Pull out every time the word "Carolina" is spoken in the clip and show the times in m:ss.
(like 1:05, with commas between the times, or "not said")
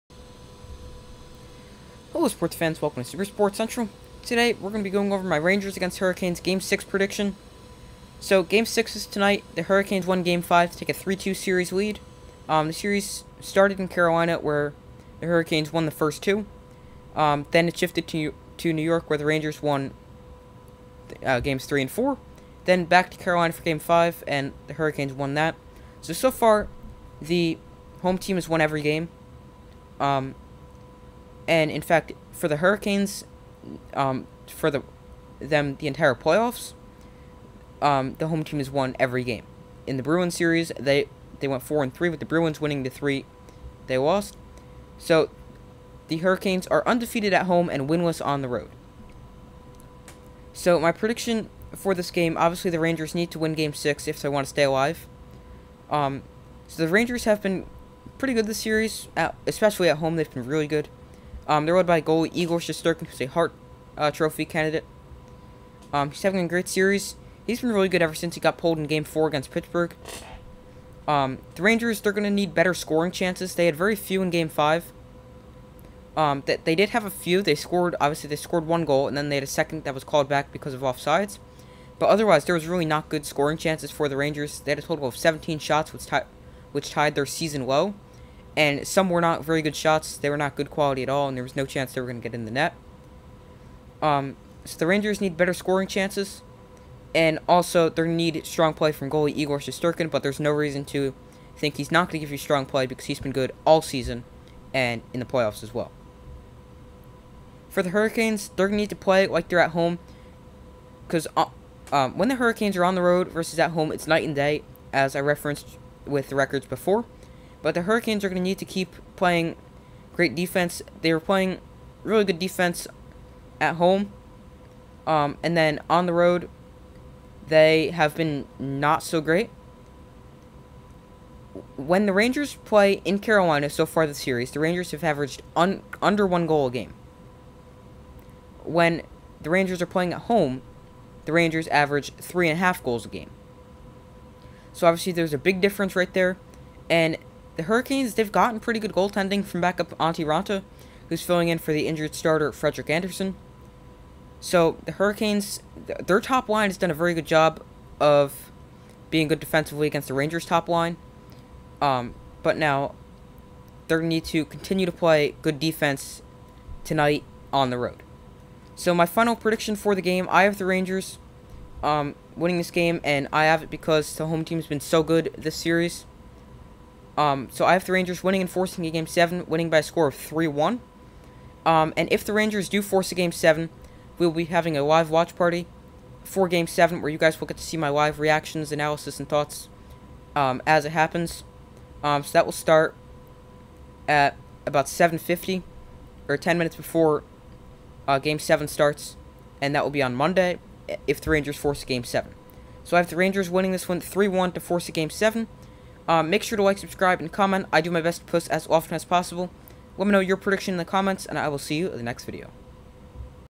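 0:13, 0:23, 2:13.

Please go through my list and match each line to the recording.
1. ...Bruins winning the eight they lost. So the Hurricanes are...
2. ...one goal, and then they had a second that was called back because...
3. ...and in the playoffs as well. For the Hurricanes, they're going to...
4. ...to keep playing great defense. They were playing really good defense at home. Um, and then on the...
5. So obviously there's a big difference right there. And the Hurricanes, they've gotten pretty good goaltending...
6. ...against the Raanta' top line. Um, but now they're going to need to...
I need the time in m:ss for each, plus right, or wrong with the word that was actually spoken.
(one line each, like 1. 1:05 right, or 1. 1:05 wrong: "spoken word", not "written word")
1. 0:42 wrong: "three", not "eight"
2. 1:18 right
3. 1:44 right
4. 1:58 right
5. 2:24 right
6. 2:39 wrong: "Rangers", not "Raanta".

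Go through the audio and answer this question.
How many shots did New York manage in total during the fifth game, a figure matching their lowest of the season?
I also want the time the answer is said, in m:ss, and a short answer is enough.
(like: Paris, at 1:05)
17, at 1:25.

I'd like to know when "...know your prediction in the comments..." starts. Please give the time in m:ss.
3:30.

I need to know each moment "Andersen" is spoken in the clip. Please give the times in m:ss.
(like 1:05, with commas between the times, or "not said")
2:32.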